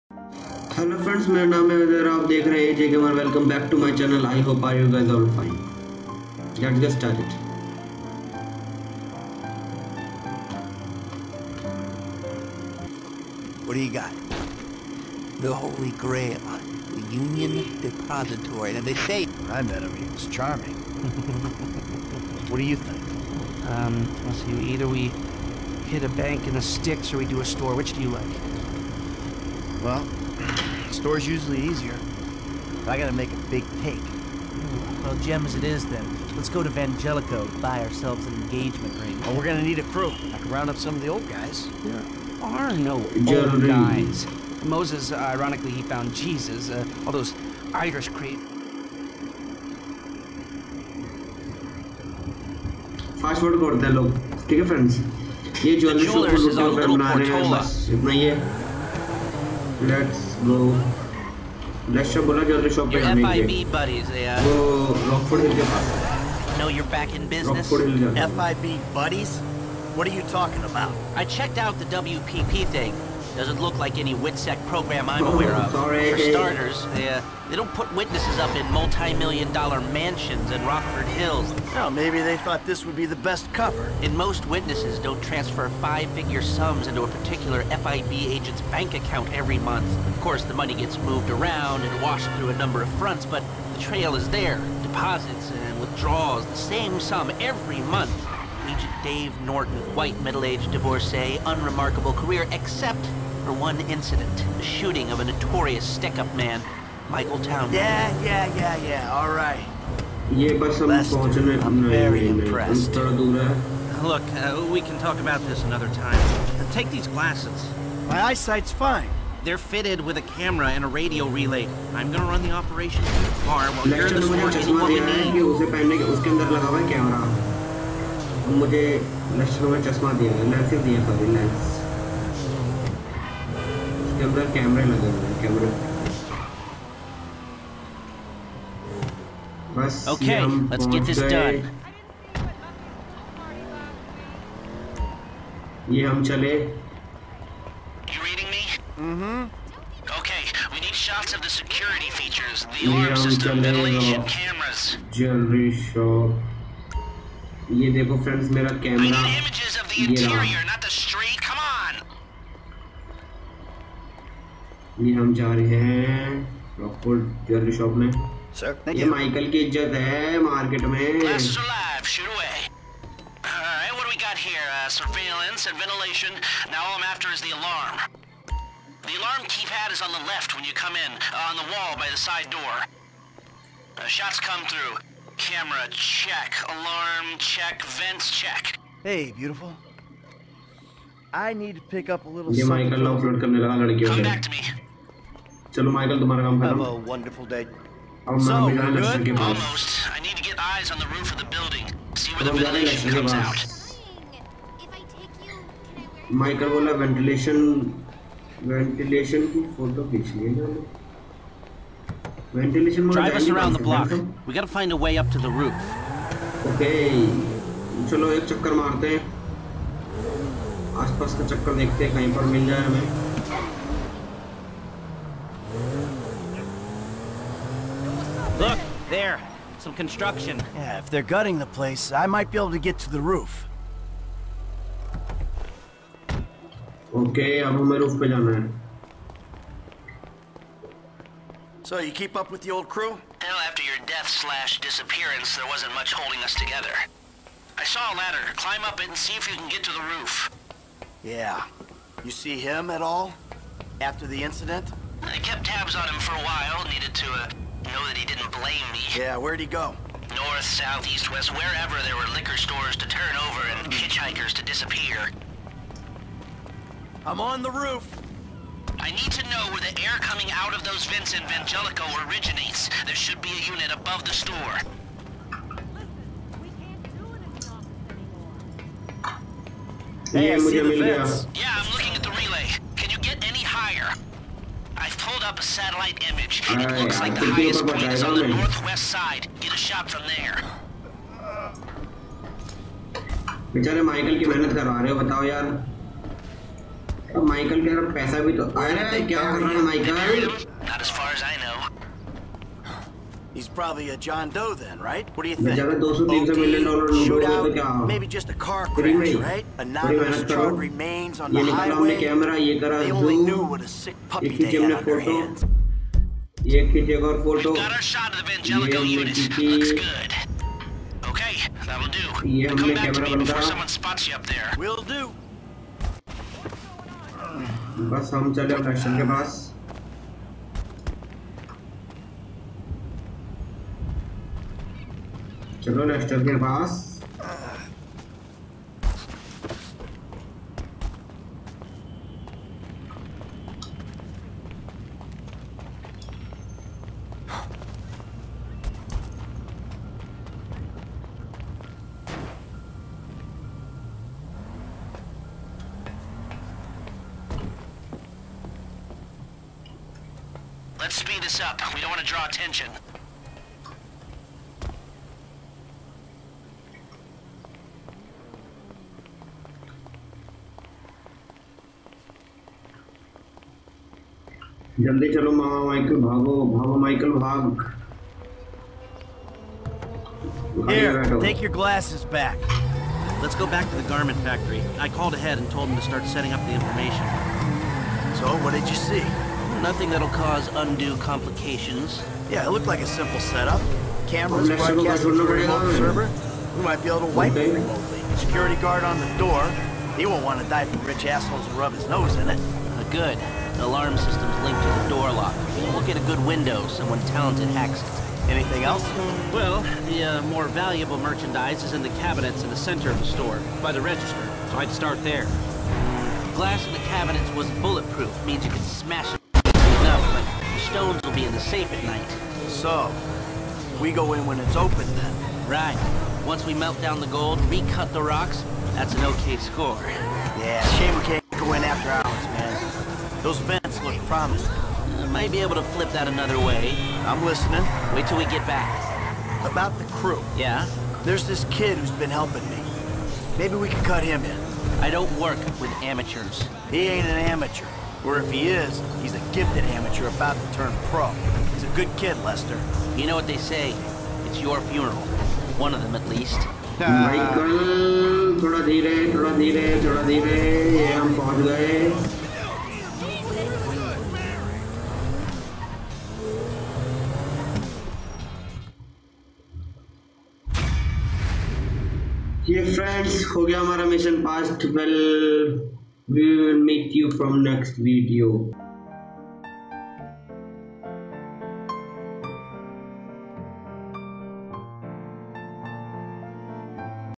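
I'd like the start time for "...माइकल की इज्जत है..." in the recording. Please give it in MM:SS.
02:49.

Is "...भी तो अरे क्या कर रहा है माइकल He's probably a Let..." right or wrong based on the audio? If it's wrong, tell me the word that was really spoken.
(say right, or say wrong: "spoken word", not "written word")
wrong: "John", not "Let".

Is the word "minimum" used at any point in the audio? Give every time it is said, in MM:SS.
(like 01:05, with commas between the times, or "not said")
not said.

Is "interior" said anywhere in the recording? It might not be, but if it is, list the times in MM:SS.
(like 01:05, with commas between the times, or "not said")
02:40.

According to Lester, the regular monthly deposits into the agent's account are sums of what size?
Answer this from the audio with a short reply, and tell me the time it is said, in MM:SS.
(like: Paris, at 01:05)
Five-figure, at 01:25.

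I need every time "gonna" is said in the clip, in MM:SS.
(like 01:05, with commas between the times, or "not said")
00:39, 02:02.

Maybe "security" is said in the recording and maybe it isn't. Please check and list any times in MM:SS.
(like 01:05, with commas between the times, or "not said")
02:31, 06:38.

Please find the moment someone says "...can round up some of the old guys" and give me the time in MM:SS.
00:40.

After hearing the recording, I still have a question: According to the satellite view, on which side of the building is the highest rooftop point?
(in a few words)
Northwest.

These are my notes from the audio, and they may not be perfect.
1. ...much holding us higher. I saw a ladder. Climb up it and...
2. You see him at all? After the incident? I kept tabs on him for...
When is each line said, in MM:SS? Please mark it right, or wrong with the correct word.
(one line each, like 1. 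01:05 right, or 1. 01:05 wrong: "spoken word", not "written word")
1. 04:05 wrong: "together", not "higher"
2. 04:12 right.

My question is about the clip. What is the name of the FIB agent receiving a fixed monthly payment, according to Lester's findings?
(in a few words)
Dave Norton.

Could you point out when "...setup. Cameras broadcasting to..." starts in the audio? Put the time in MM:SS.
06:33.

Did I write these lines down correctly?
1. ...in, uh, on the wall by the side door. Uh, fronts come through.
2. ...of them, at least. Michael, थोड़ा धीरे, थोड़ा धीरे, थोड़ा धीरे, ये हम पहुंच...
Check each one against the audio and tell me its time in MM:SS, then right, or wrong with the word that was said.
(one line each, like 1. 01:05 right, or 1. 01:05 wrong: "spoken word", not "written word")
1. 03:01 wrong: "shots", not "fronts"
2. 07:35 right.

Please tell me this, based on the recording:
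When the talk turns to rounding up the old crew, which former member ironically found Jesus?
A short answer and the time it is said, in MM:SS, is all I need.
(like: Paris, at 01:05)
Moses, at 00:44.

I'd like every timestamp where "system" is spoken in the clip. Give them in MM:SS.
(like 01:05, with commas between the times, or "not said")
02:33, 06:44.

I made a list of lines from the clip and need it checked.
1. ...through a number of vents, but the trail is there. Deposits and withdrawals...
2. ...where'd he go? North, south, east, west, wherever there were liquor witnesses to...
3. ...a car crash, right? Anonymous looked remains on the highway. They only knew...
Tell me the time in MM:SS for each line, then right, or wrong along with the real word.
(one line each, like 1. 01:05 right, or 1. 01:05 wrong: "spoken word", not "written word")
1. 01:32 wrong: "fronts", not "vents"
2. 04:19 wrong: "stores", not "witnesses"
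3. 05:08 wrong: "charred", not "looked".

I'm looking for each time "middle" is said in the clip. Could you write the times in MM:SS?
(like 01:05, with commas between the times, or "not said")
01:40.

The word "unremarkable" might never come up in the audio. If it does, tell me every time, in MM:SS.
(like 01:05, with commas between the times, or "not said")
01:41.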